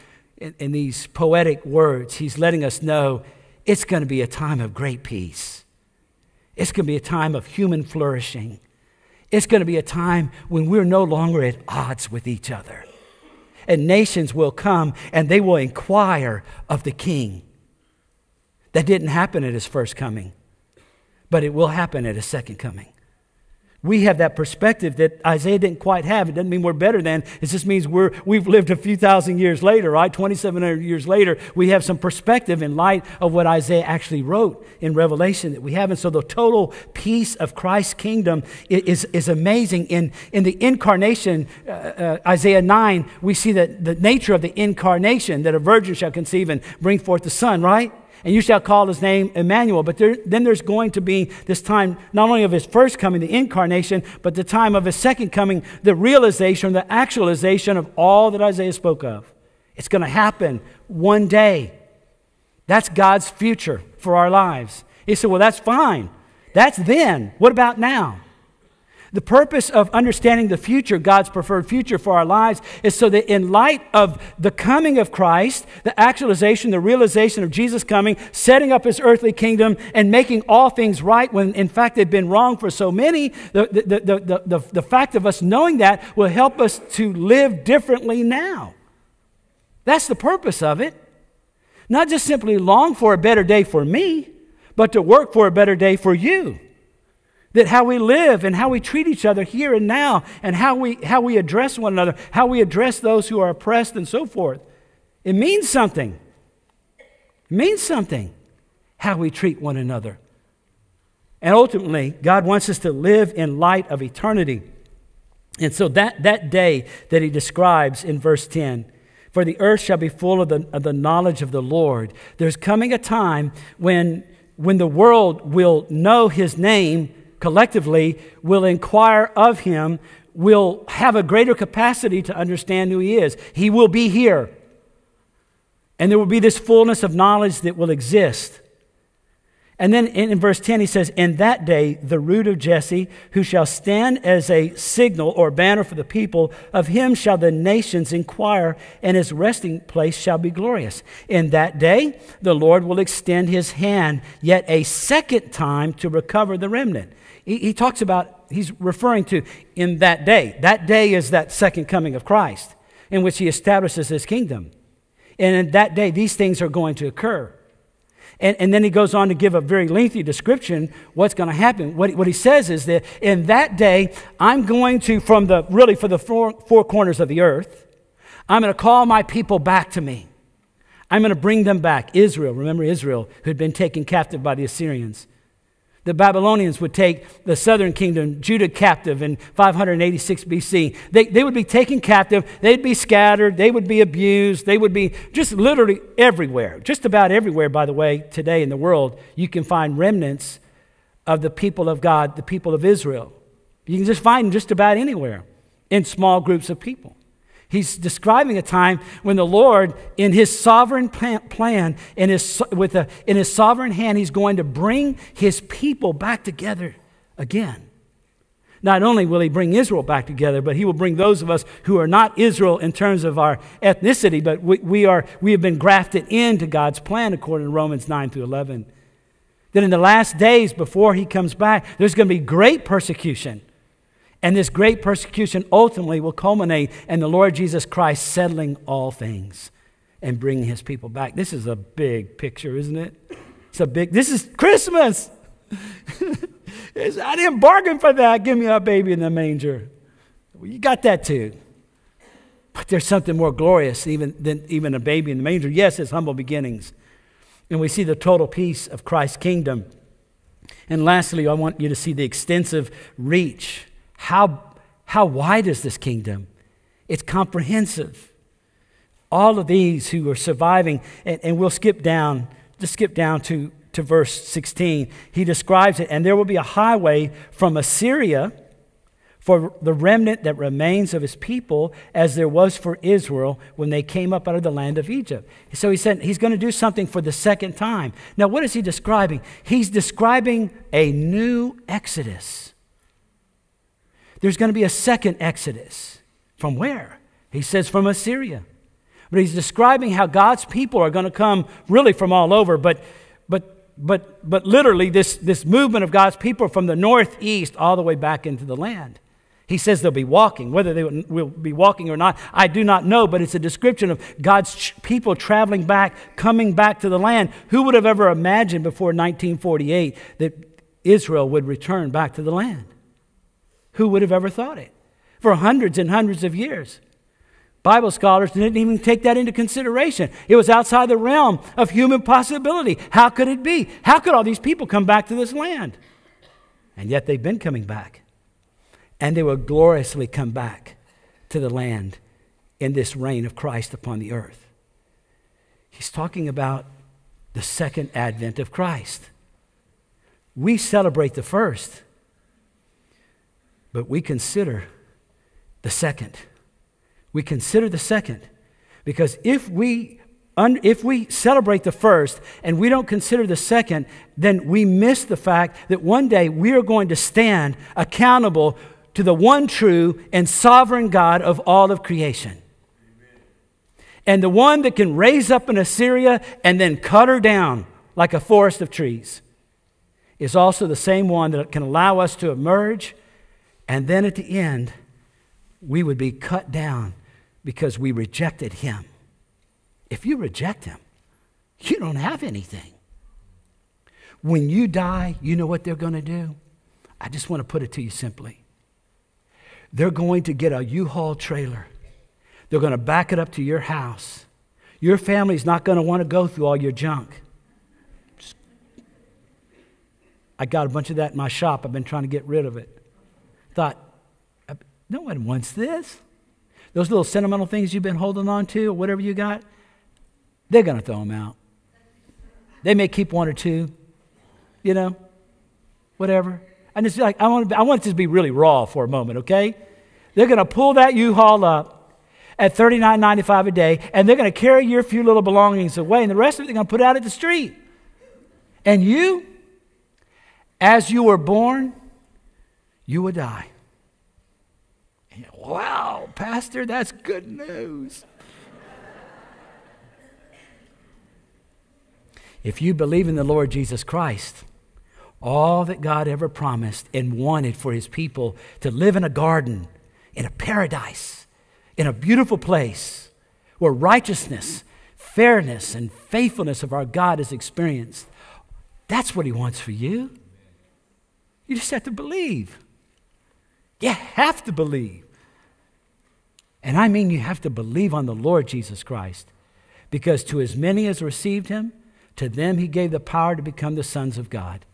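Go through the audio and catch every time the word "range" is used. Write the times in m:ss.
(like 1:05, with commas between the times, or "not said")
not said.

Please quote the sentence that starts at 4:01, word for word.
This is a big picture, isn't it?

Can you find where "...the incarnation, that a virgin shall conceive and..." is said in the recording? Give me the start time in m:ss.
0:44.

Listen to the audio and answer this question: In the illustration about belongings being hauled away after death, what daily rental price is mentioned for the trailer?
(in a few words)
$39.95.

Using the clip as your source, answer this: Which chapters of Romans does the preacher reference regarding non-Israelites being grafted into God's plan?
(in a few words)
Romans 9 through 11.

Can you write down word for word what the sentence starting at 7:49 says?
That's what he wants for you.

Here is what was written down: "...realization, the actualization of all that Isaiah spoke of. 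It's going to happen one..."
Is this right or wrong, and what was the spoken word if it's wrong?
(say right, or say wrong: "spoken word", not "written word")
right.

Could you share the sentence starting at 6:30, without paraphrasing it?
If you reject him, you don't have anything.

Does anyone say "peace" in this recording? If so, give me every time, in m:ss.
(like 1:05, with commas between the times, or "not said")
0:05, 0:36, 4:18.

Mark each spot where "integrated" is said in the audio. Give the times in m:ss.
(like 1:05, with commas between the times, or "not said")
not said.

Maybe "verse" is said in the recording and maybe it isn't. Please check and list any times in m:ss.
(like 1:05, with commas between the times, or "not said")
1:58, 2:20, 4:34.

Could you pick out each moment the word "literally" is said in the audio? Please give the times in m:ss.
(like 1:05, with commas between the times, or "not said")
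3:15, 5:04.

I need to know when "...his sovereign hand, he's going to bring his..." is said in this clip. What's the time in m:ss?
3:33.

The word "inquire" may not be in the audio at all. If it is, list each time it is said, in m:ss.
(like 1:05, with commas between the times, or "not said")
0:15, 2:08, 2:28.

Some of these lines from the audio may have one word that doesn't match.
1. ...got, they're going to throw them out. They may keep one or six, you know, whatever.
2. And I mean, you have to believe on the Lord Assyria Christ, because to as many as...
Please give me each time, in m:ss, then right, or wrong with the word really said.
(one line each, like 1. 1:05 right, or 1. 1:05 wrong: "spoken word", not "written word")
1. 6:59 wrong: "two", not "six"
2. 7:56 wrong: "Jesus", not "Assyria".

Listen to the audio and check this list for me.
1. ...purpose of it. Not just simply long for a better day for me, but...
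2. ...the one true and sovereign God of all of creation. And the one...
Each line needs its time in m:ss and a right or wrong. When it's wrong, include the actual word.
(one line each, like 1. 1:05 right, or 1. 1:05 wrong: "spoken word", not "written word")
1. 1:30 right
2. 6:09 right.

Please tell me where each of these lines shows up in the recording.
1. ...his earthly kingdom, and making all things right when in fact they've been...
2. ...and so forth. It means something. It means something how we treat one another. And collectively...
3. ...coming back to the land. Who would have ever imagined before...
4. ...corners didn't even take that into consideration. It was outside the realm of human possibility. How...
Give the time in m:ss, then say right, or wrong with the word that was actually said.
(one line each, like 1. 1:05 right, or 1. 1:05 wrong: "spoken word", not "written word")
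1. 1:18 right
2. 1:43 wrong: "ultimately", not "collectively"
3. 5:16 right
4. 5:28 wrong: "scholars", not "corners".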